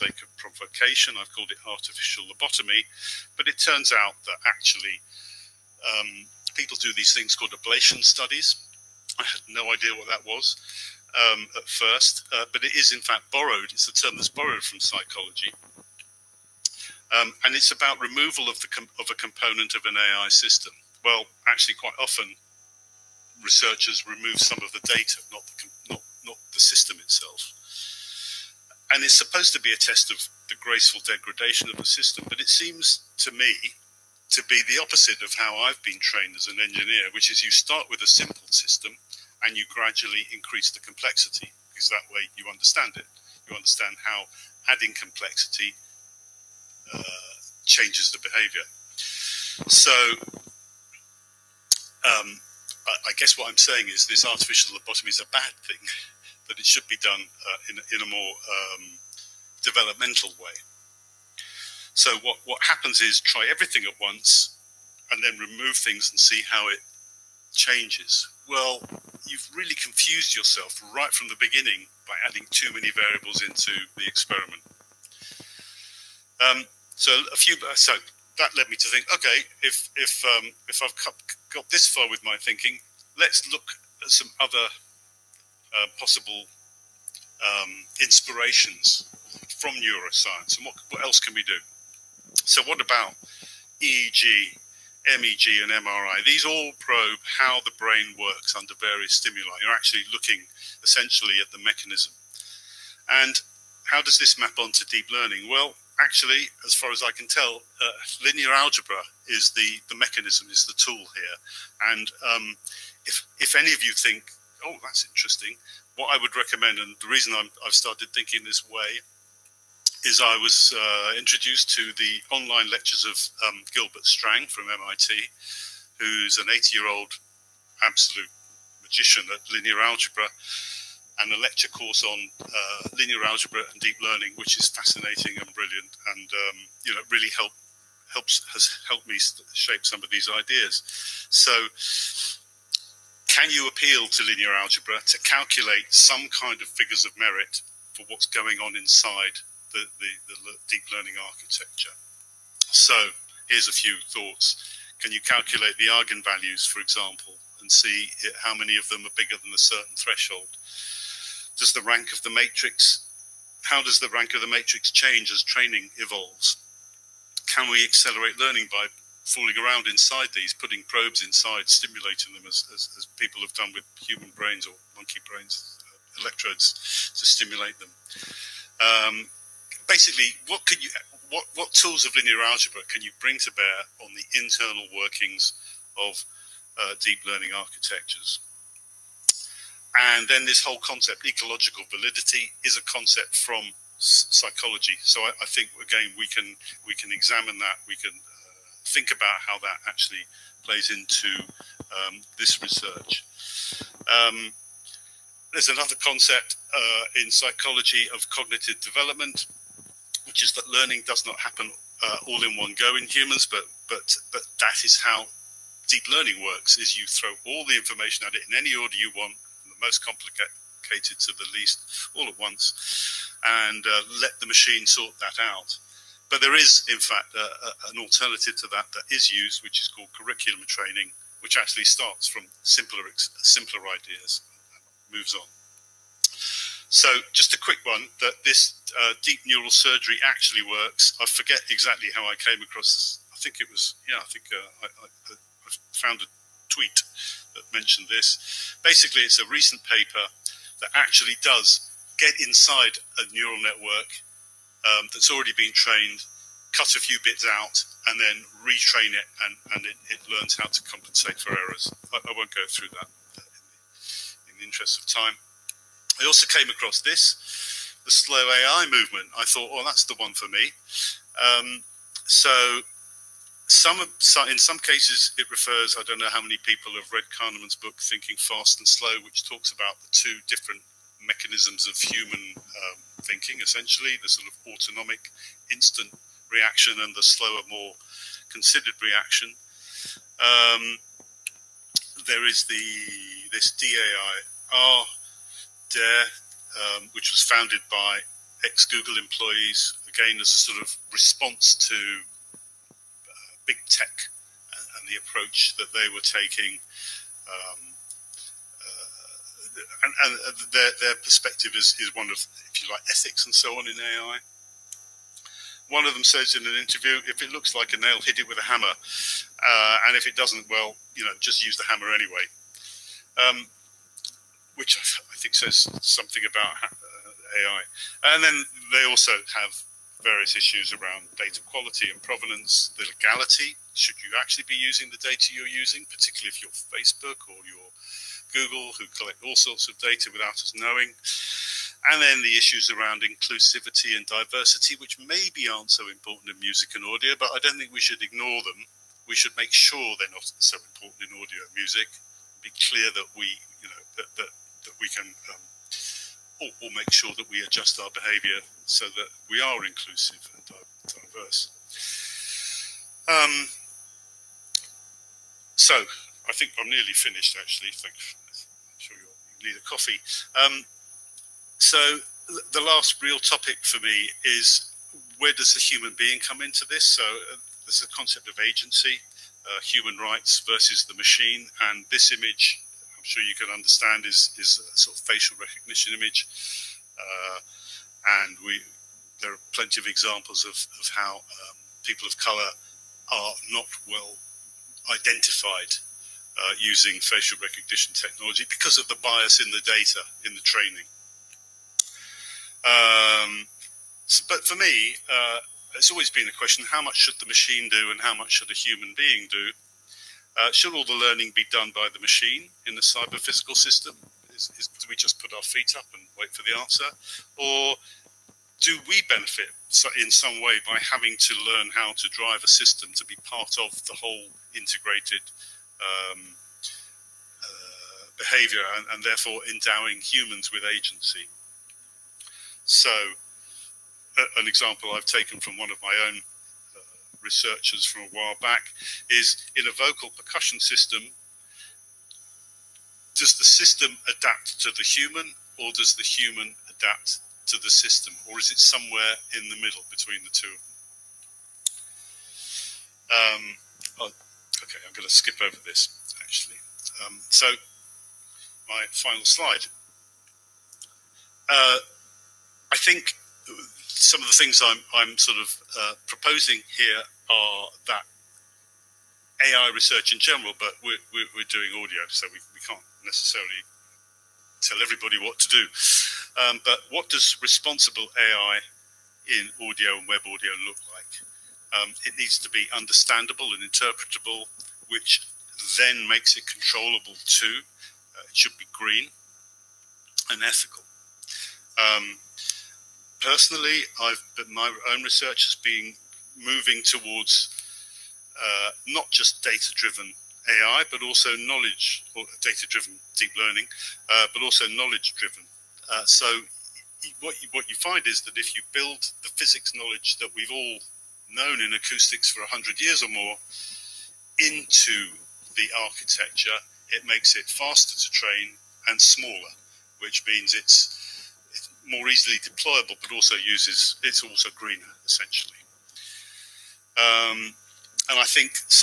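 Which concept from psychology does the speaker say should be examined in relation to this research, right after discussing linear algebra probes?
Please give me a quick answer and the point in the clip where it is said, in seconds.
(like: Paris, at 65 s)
ecological validity, at 191 s.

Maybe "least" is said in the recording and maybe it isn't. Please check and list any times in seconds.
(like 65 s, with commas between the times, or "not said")
221 s.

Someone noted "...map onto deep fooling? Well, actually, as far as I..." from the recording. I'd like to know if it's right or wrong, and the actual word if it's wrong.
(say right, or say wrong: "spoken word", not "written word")
wrong: "learning", not "fooling".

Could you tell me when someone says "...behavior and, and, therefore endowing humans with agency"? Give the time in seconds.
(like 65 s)
428 s.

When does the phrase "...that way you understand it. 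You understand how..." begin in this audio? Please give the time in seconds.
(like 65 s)
41 s.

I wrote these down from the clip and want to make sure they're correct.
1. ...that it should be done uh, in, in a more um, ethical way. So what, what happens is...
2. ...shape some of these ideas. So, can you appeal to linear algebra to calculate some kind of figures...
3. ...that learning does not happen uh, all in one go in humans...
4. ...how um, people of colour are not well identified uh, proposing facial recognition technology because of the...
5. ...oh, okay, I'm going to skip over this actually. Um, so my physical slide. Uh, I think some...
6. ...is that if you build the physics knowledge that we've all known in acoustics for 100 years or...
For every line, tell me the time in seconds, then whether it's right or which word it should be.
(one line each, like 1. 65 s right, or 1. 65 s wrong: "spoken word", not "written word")
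1. 56 s wrong: "developmental", not "ethical"
2. 139 s right
3. 210 s right
4. 391 s wrong: "using", not "proposing"
5. 454 s wrong: "final", not "physical"
6. 508 s right.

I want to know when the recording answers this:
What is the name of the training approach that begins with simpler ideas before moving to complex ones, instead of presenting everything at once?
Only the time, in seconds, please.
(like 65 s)
230 s.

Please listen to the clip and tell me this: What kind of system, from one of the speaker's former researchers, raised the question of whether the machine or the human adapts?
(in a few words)
vocal percussion system.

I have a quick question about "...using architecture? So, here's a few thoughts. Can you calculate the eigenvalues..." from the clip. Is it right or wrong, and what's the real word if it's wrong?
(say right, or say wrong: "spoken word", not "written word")
wrong: "learning", not "using".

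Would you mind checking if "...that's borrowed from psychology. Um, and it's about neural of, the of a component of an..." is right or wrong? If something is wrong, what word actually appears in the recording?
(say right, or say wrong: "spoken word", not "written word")
wrong: "removal", not "neural".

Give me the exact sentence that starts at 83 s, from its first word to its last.
Let's look at some other uh, possible um, inspirations from neuroscience and what, what else can we do?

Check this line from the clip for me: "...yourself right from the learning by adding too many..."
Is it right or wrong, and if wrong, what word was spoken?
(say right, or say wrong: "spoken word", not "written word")
wrong: "beginning", not "learning".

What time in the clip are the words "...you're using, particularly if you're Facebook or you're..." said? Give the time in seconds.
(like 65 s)
335 s.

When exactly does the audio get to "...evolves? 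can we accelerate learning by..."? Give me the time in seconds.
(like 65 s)
165 s.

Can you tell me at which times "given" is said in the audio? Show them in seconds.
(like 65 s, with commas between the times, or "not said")
not said.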